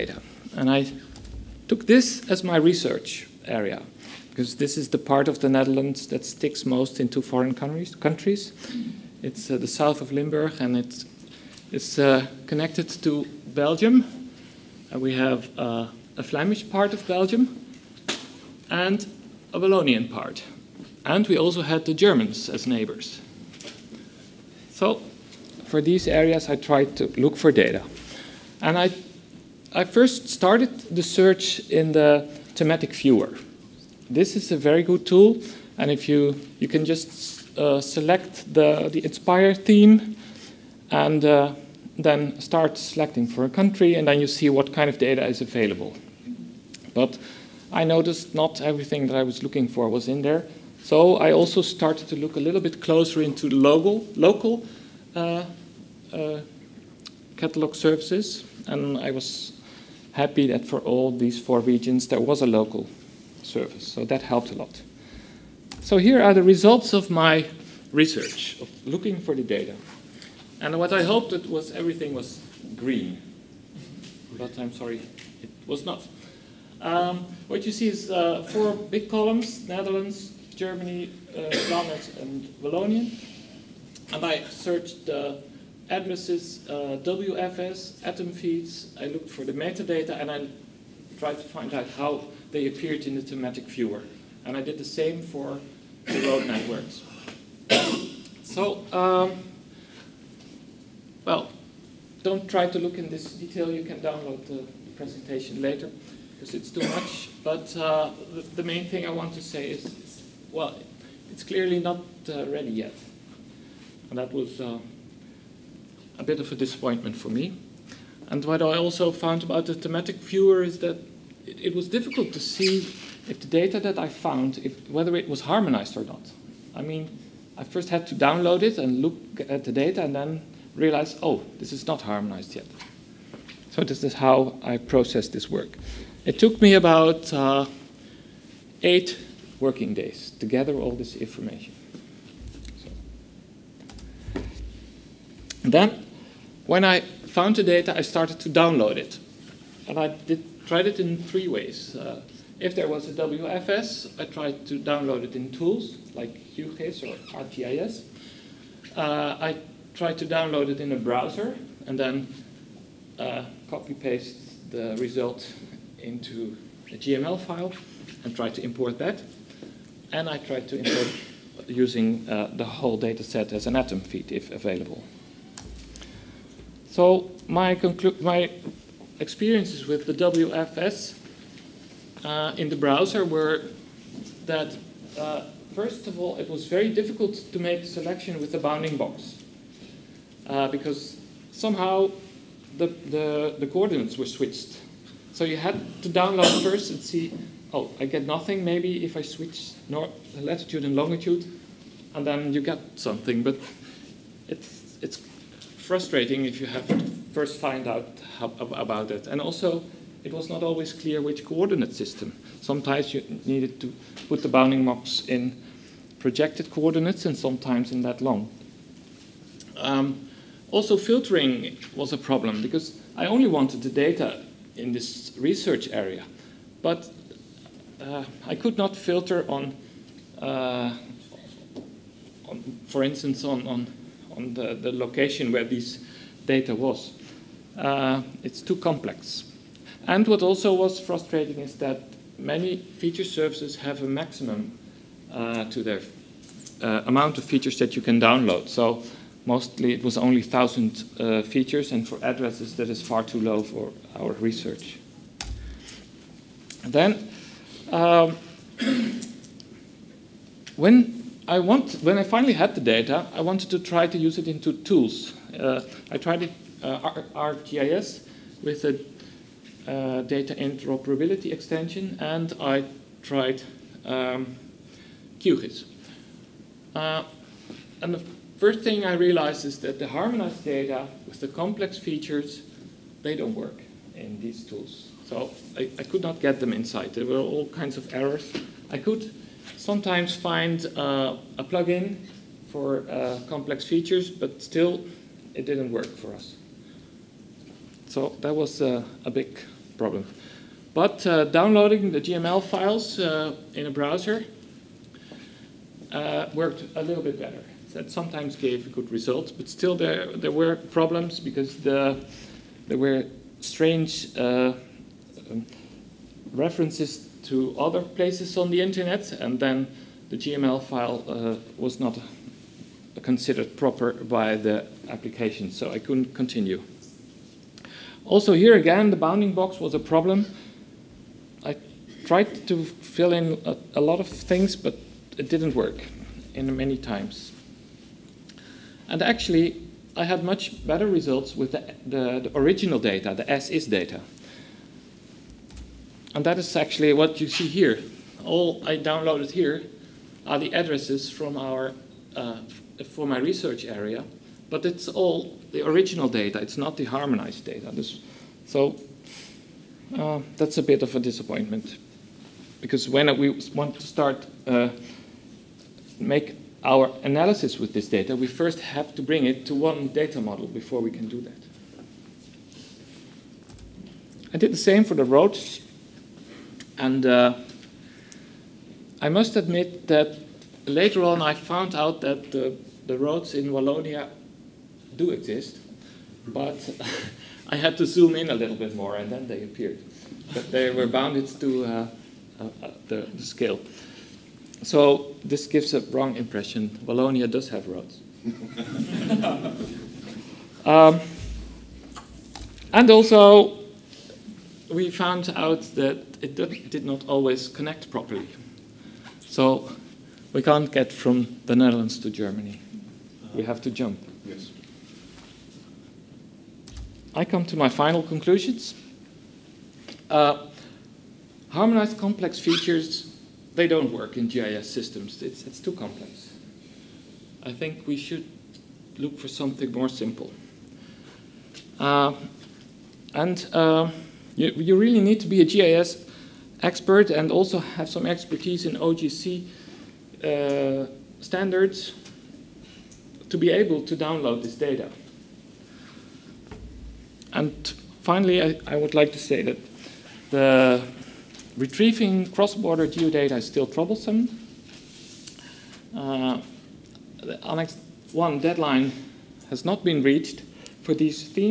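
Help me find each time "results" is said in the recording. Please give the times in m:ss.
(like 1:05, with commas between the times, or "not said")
1:06, 2:44, 5:09, 5:41.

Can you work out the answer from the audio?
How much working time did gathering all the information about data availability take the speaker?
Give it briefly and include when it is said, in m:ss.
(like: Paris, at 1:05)
8 working days, at 2:18.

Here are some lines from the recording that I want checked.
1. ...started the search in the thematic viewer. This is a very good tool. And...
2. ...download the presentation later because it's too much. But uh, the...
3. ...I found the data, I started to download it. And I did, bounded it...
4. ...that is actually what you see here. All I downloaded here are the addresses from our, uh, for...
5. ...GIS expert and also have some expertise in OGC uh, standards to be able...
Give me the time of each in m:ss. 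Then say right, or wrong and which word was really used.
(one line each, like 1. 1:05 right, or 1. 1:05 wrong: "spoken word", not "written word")
1. 0:30 right
2. 1:43 right
3. 2:26 wrong: "tried", not "bounded"
4. 5:46 right
5. 7:15 right.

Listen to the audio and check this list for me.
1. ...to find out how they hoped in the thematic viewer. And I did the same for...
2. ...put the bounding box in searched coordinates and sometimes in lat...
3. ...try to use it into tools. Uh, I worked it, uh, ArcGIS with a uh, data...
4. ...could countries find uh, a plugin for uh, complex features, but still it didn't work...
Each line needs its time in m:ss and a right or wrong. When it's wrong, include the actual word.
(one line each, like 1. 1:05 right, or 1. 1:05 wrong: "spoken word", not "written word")
1. 1:31 wrong: "appeared", not "hoped"
2. 3:34 wrong: "projected", not "searched"
3. 4:23 wrong: "tried", not "worked"
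4. 4:48 wrong: "sometimes", not "countries".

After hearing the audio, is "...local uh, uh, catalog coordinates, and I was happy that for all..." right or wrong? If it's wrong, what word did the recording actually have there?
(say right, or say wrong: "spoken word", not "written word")
wrong: "services", not "coordinates".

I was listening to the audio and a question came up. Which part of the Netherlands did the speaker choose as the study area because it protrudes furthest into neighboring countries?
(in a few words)
South of Limburg.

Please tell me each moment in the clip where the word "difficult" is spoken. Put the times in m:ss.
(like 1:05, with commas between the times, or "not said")
2:01, 3:06.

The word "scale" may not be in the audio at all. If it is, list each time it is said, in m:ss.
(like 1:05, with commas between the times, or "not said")
6:33.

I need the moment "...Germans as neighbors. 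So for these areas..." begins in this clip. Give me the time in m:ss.
0:21.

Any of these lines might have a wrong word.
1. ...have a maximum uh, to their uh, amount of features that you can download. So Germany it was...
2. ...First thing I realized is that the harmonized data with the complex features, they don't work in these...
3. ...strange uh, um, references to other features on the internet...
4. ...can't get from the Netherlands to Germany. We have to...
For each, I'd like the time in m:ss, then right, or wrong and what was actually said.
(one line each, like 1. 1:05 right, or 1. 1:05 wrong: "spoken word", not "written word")
1. 4:03 wrong: "Mostly", not "Germany"
2. 4:38 right
3. 5:13 wrong: "places", not "features"
4. 6:50 right.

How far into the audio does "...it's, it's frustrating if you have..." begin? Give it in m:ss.
3:24.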